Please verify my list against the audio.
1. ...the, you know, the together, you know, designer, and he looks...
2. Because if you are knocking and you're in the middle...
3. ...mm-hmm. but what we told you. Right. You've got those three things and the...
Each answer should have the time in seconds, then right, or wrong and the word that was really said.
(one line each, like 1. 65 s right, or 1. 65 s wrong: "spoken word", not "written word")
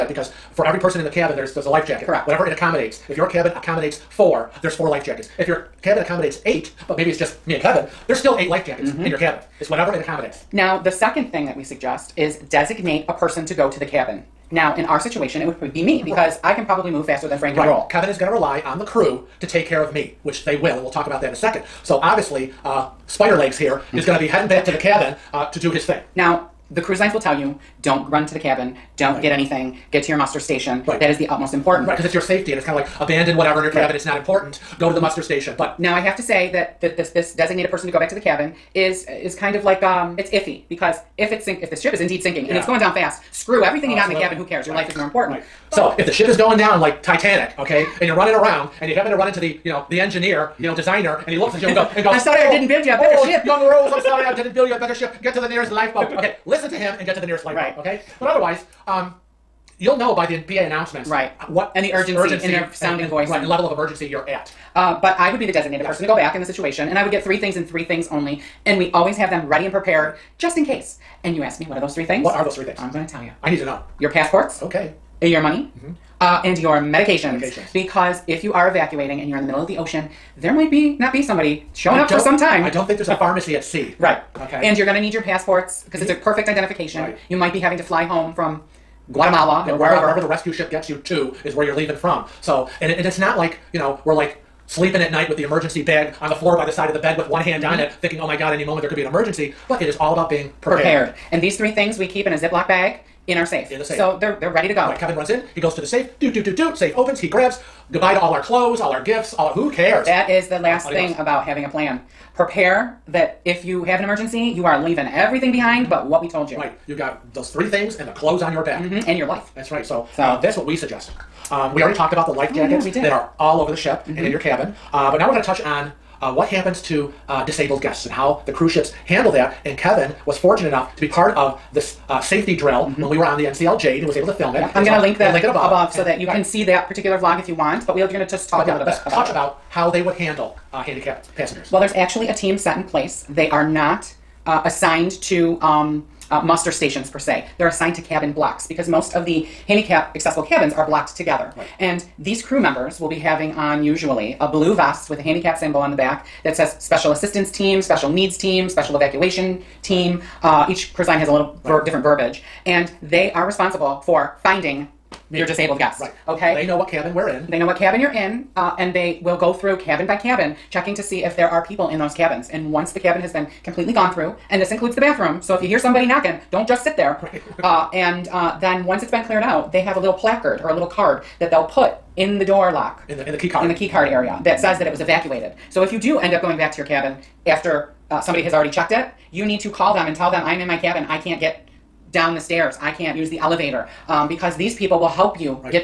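1. 49 s wrong: "engineer", not "together"
2. 77 s wrong: "evacuating", not "knocking"
3. 115 s right.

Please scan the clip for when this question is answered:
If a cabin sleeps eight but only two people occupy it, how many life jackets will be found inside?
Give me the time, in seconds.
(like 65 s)
8 s.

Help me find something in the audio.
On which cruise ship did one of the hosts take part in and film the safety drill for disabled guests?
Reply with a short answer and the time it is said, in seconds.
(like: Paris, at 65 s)
NCL Jade, at 133 s.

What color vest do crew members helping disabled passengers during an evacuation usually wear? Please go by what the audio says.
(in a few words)
Blue.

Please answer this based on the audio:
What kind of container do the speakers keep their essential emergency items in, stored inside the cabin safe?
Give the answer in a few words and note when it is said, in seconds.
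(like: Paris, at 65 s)
Ziploc bag, at 102 s.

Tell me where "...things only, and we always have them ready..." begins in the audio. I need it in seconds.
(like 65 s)
67 s.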